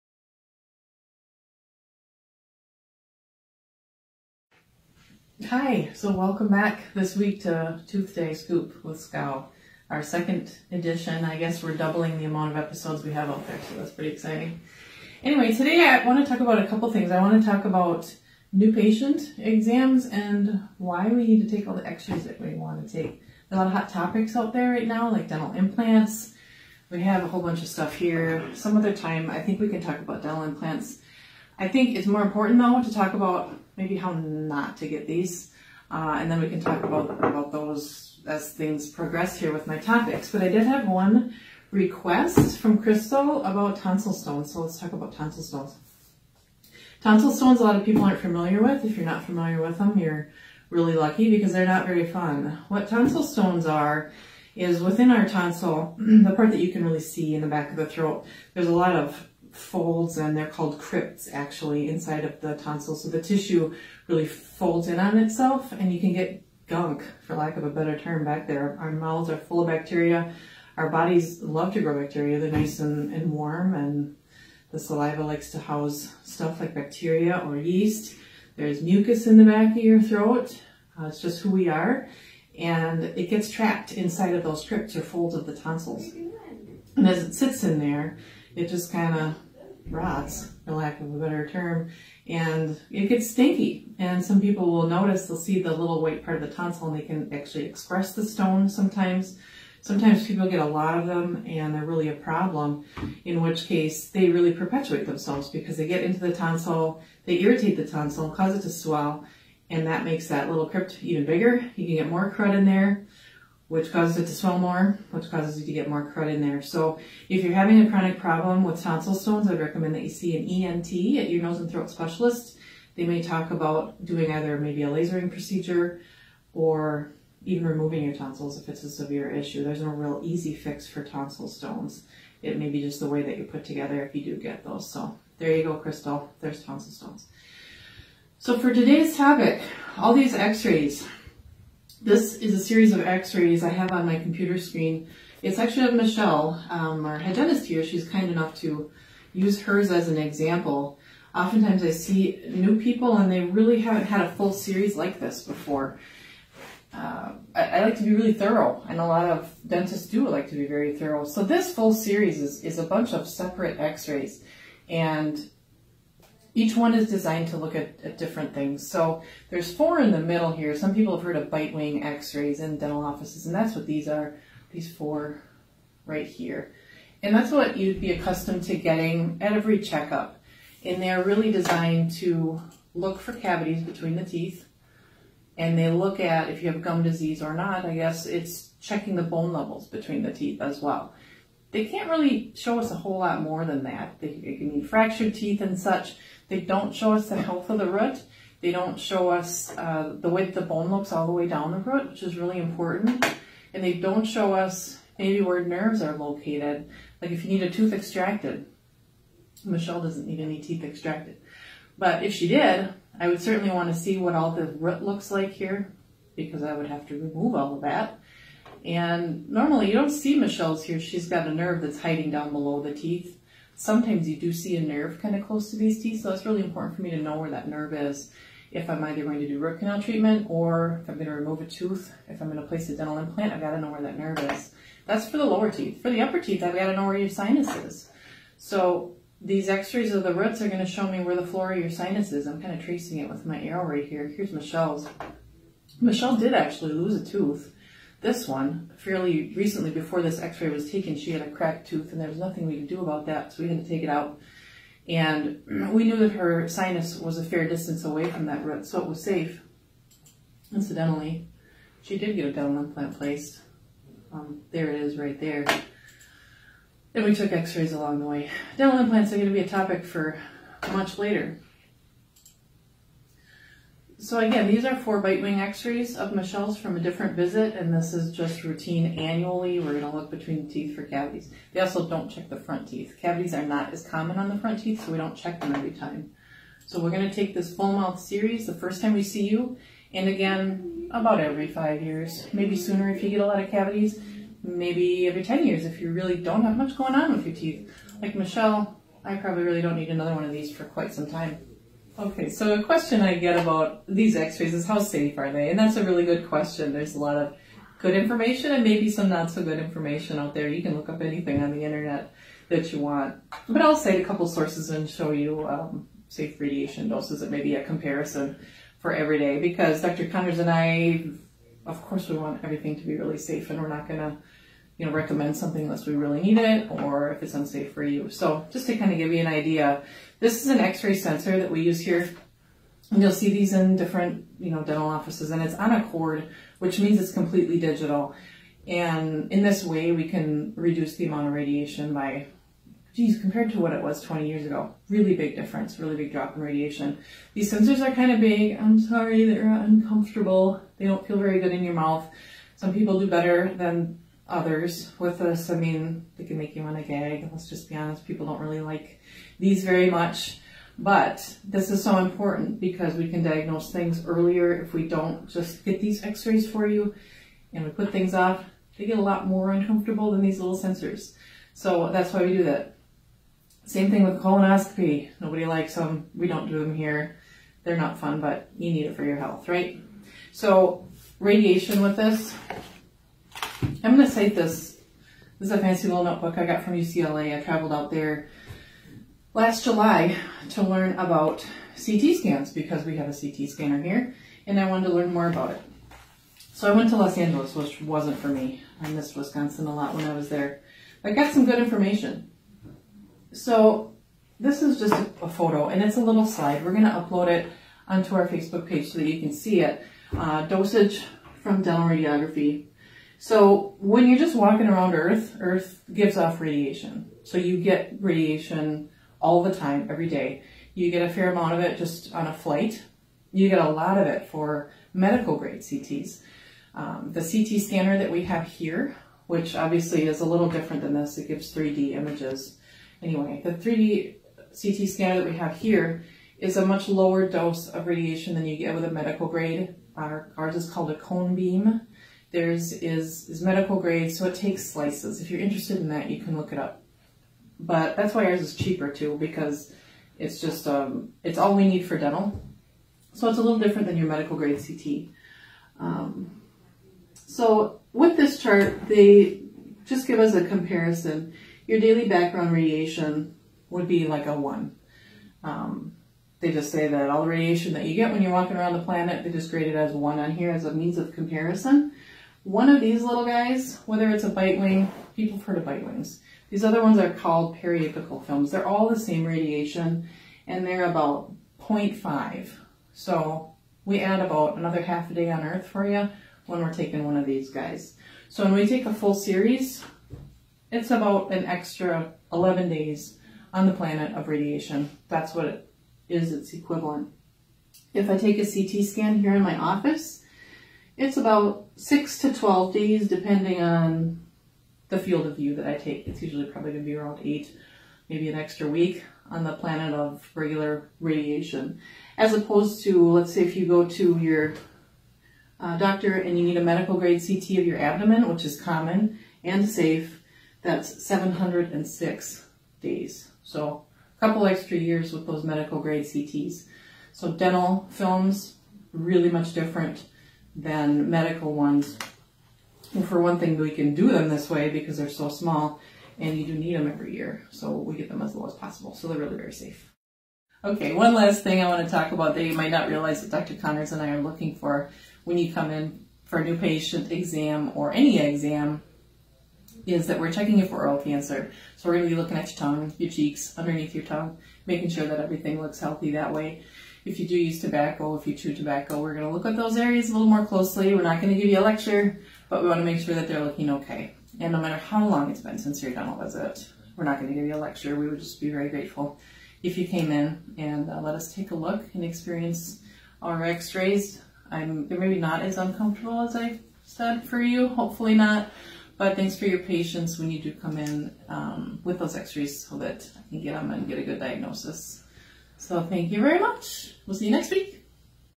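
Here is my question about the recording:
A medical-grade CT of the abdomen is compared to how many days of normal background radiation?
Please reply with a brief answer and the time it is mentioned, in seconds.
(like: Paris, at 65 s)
706 days, at 521 s.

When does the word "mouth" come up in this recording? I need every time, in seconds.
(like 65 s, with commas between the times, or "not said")
68 s, 287 s, 351 s.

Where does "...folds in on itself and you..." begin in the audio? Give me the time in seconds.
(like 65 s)
64 s.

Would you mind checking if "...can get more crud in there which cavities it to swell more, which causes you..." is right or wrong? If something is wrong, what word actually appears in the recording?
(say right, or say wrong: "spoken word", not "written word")
wrong: "causes", not "cavities".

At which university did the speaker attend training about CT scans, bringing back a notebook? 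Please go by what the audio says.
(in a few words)
UCLA.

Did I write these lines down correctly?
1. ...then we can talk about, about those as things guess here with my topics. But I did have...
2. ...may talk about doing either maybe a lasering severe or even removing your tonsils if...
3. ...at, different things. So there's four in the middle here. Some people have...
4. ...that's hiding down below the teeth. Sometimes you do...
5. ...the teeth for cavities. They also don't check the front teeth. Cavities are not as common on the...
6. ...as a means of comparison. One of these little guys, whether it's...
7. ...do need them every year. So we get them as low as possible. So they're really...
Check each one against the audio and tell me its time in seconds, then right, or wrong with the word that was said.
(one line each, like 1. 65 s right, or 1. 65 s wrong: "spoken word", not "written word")
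1. 36 s wrong: "progress", not "guess"
2. 123 s wrong: "procedure", not "severe"
3. 168 s right
4. 221 s right
5. 280 s right
6. 470 s right
7. 536 s right.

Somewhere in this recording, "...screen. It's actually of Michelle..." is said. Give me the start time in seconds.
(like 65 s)
144 s.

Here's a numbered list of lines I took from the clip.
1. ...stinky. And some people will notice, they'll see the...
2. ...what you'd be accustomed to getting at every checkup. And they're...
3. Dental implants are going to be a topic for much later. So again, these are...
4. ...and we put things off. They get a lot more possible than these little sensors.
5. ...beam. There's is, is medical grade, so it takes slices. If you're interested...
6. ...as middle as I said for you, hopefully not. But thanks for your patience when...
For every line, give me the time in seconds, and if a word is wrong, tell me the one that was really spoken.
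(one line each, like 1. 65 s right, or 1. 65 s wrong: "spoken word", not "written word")
1. 93 s right
2. 177 s right
3. 268 s right
4. 367 s wrong: "uncomfortable", not "possible"
5. 441 s right
6. 575 s wrong: "uncomfortable", not "middle".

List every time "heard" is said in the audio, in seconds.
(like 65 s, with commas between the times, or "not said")
171 s, 475 s.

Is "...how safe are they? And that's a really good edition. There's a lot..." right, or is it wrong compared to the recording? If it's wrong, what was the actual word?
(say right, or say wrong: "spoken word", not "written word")
wrong: "question", not "edition".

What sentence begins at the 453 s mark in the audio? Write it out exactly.
So it's a little different than your medical grade CT.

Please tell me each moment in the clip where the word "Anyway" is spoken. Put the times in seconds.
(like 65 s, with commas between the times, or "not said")
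15 s, 433 s.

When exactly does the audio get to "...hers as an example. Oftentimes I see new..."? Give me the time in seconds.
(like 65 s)
149 s.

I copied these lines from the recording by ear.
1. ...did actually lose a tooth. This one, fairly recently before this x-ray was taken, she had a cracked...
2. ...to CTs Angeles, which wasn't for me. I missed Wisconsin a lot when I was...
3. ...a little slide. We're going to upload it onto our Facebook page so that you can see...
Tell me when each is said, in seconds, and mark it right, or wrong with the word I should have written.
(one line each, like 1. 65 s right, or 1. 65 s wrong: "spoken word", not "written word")
1. 246 s right
2. 397 s wrong: "Los", not "CTs"
3. 406 s right.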